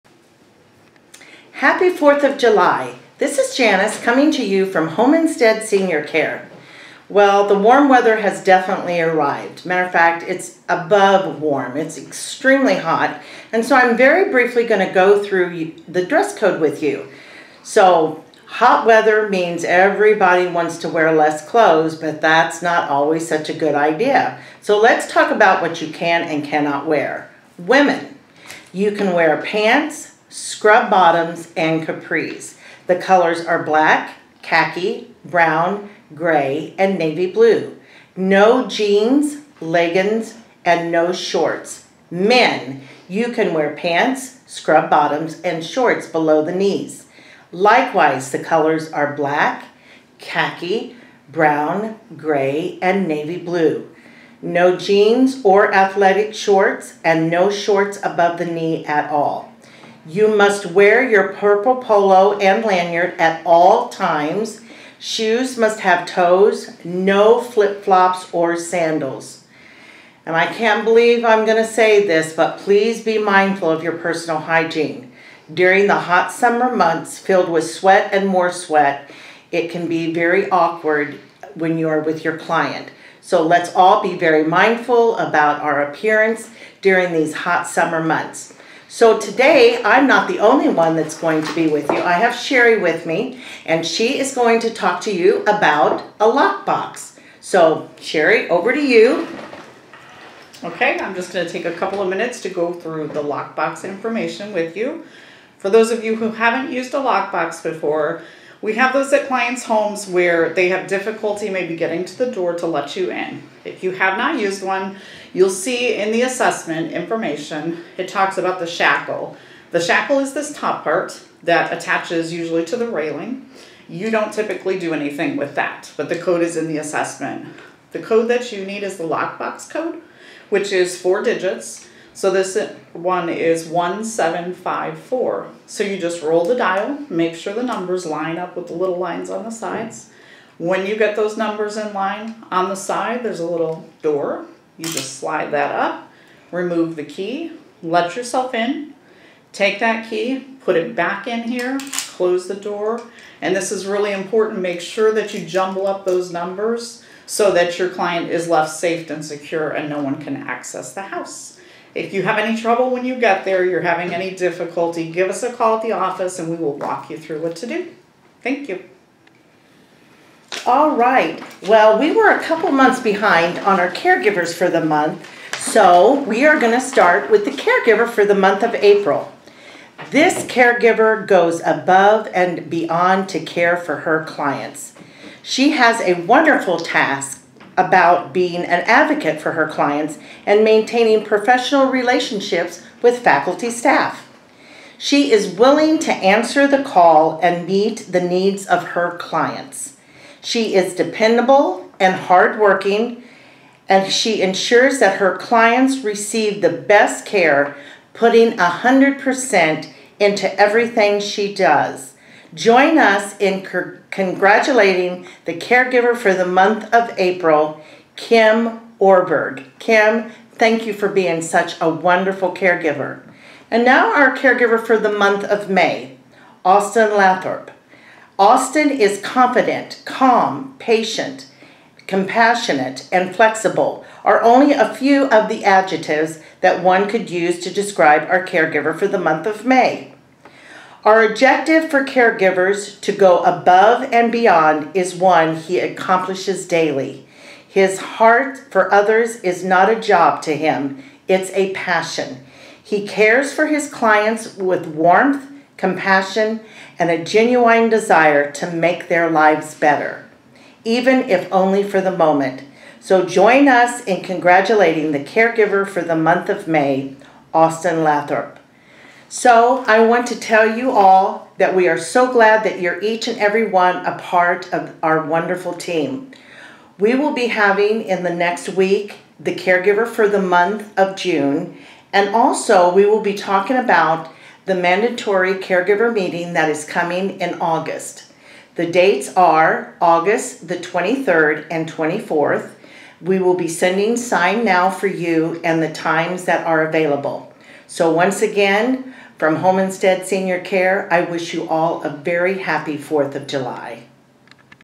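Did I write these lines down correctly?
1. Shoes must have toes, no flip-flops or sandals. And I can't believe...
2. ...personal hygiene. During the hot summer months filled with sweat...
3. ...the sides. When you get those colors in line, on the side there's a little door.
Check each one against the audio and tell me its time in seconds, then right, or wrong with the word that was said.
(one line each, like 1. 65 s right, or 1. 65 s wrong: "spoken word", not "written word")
1. 64 s right
2. 73 s right
3. 139 s wrong: "numbers", not "colors".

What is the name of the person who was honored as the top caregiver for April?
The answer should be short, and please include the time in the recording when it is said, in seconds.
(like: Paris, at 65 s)
Kim Orberg, at 218 s.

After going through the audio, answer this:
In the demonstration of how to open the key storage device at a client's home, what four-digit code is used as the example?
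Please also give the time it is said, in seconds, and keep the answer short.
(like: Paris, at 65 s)
1754, at 133 s.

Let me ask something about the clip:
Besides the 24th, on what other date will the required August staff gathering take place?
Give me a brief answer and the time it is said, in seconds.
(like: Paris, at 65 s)
August 23, at 289 s.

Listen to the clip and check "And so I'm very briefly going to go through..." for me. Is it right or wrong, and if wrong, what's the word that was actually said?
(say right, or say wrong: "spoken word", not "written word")
right.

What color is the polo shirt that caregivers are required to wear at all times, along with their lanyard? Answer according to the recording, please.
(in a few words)
Purple.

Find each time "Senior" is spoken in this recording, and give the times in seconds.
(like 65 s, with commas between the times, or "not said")
5 s, 300 s.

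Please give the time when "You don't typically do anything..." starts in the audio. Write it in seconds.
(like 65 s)
123 s.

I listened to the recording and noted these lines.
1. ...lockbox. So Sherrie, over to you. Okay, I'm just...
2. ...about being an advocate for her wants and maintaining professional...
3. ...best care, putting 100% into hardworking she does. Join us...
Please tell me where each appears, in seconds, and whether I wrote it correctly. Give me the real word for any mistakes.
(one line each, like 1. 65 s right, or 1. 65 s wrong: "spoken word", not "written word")
1. 96 s right
2. 187 s wrong: "clients", not "wants"
3. 206 s wrong: "everything", not "hardworking".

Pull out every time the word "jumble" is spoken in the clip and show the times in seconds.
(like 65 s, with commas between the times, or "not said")
155 s.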